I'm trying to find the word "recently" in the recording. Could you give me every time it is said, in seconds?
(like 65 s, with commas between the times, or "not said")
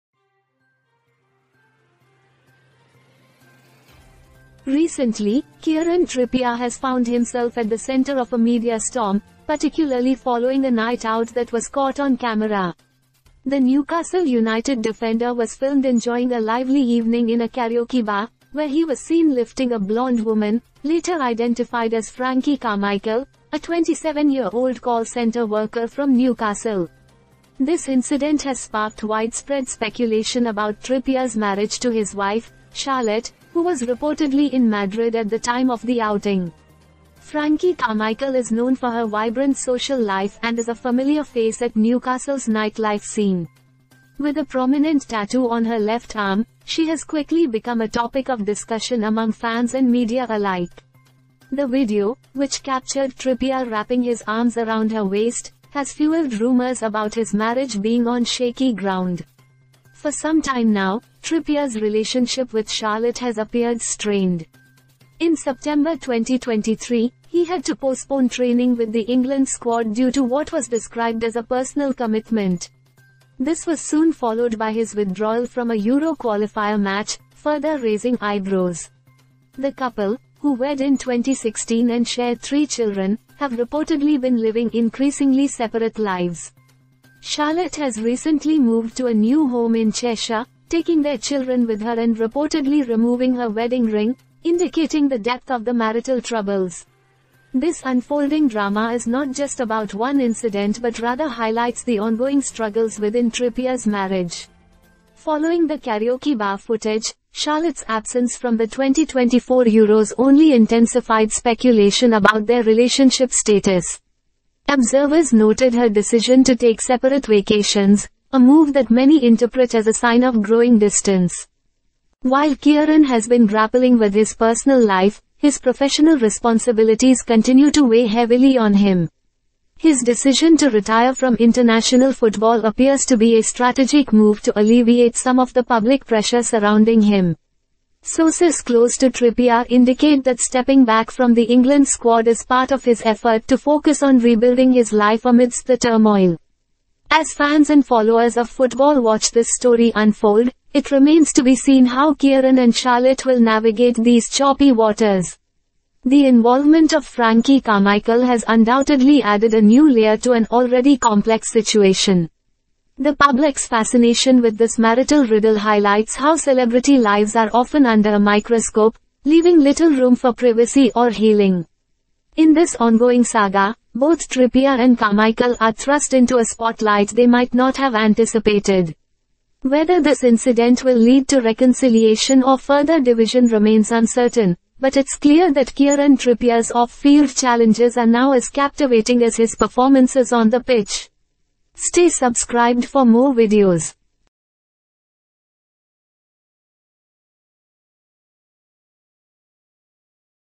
4 s, 88 s.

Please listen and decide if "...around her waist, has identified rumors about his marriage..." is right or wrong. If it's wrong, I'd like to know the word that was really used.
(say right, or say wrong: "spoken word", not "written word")
wrong: "fueled", not "identified".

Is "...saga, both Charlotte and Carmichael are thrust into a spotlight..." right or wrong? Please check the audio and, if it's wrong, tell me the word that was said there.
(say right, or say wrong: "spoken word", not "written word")
wrong: "Trippier", not "Charlotte".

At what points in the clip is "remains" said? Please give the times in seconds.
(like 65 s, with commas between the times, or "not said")
150 s, 183 s.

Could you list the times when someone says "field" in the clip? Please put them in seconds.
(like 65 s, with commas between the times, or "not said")
186 s.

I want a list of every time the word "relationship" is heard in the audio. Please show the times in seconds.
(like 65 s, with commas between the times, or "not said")
61 s, 112 s.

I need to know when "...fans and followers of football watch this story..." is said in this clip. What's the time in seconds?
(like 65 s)
147 s.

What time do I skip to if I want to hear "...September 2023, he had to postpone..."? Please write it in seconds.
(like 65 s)
65 s.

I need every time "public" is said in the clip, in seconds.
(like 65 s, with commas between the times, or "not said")
135 s, 163 s.